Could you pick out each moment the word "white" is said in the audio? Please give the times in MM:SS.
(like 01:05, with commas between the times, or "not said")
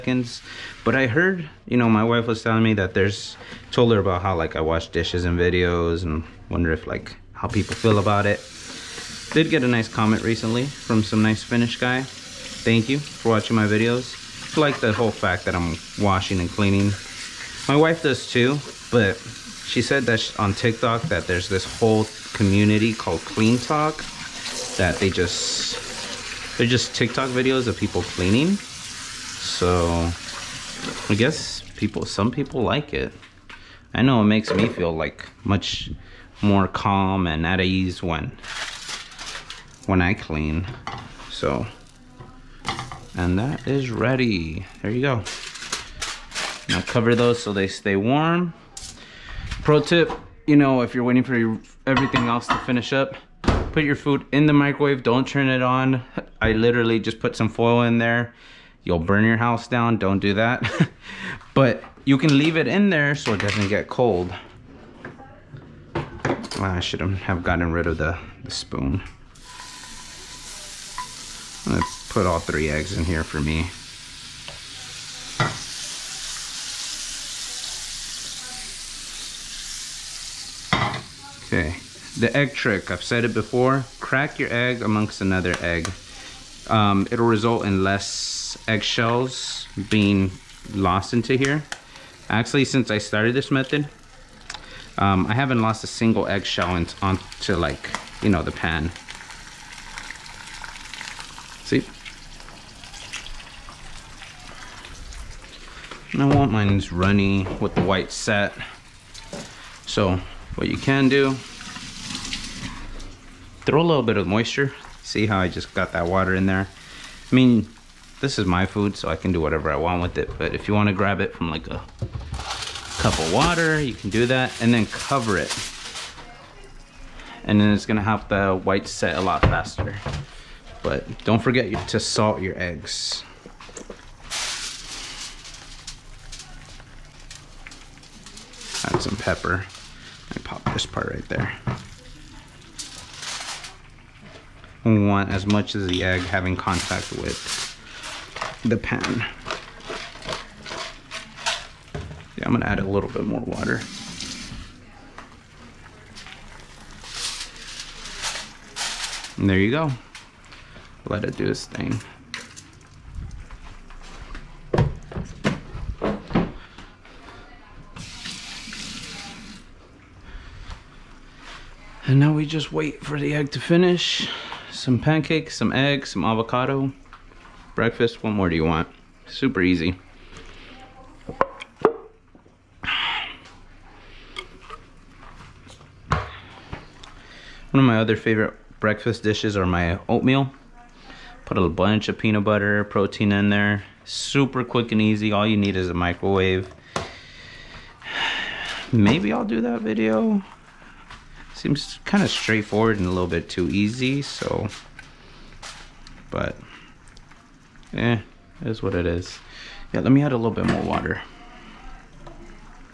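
01:47, 02:08.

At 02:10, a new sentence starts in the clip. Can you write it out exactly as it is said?
But don't forget to salt your eggs.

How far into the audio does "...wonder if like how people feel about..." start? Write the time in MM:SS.
00:06.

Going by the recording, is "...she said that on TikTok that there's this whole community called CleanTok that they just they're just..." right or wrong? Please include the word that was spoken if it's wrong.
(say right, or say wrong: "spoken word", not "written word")
right.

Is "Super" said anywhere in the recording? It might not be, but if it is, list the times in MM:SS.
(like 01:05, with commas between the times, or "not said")
02:59, 03:14.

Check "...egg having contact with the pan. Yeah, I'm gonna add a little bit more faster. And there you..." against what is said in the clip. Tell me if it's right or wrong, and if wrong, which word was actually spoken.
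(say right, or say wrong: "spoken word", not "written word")
wrong: "water", not "faster".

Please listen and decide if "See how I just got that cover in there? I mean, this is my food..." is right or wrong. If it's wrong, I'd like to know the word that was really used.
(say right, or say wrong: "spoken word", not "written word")
wrong: "water", not "cover".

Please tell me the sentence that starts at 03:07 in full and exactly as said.
One of my other favorite breakfast dishes are my oatmeal.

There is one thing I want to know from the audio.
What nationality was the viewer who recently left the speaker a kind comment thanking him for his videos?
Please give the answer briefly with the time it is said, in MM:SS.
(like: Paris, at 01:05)
Finnish, at 00:11.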